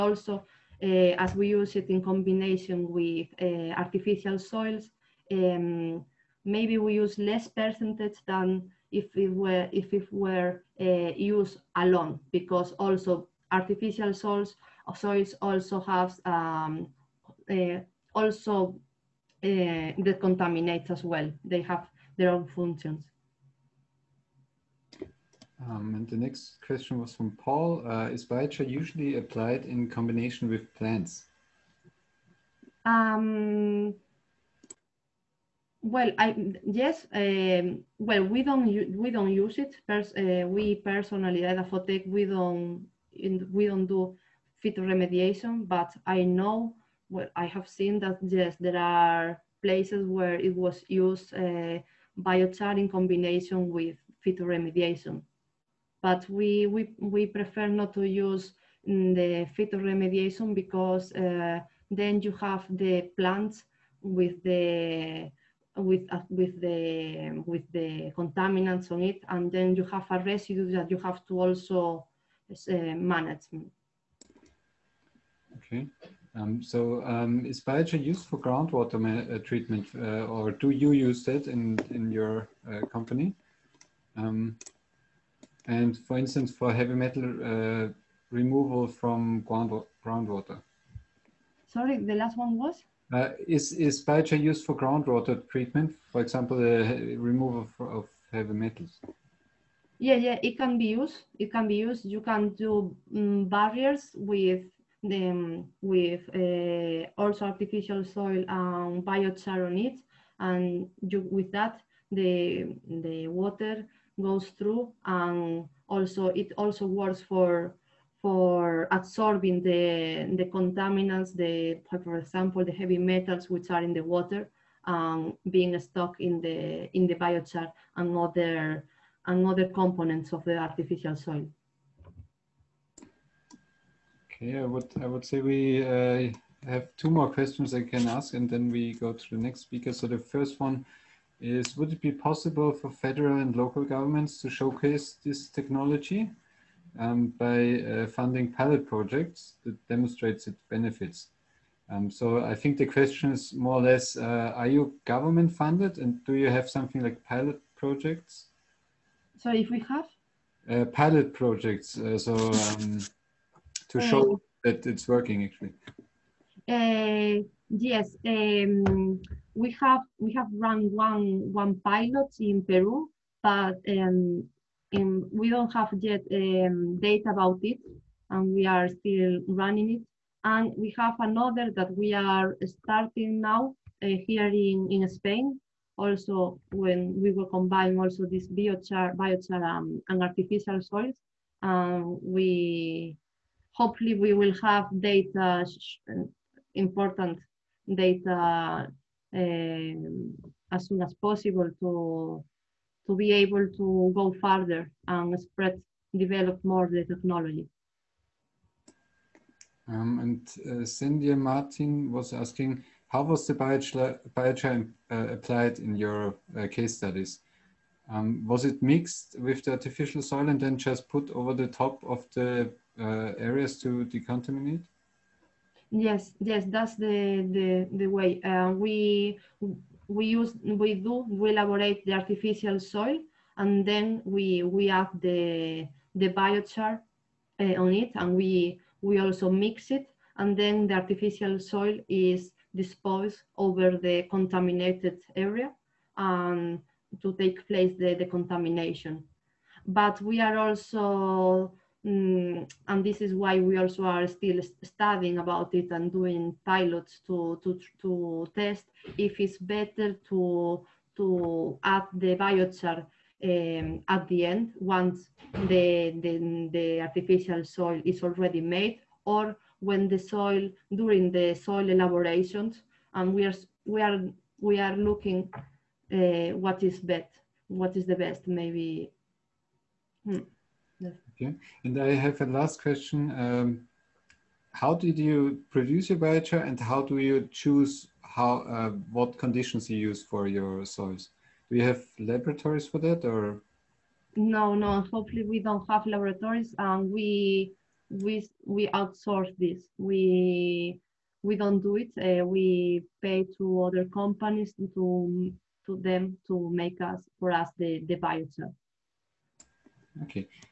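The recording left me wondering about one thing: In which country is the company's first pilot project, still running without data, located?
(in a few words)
Peru.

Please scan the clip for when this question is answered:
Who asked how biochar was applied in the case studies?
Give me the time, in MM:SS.
03:30.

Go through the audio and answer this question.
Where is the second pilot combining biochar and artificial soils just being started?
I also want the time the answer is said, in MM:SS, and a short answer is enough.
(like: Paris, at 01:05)
Spain, at 03:05.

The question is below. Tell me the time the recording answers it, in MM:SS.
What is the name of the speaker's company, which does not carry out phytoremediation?
00:41.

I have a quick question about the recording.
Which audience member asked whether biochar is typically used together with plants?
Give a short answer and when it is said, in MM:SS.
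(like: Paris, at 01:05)
Paul, at 00:27.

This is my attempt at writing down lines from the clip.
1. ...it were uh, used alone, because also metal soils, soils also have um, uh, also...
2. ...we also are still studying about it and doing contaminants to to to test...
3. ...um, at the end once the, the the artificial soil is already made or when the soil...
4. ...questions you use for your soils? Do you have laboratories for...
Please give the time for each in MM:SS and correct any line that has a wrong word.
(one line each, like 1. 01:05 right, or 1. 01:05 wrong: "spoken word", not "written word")
1. 00:09 wrong: "artificial", not "metal"
2. 04:13 wrong: "pilots", not "contaminants"
3. 04:23 right
4. 04:49 wrong: "conditions", not "questions".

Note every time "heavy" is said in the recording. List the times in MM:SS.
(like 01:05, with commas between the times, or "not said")
01:26, 01:38, 02:02.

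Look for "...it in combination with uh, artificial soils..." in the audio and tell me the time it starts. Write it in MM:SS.
00:01.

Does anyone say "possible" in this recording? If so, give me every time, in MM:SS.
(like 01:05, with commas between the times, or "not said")
02:22, 03:21.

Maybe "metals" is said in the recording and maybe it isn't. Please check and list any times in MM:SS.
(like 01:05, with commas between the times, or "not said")
01:26, 01:38, 02:02.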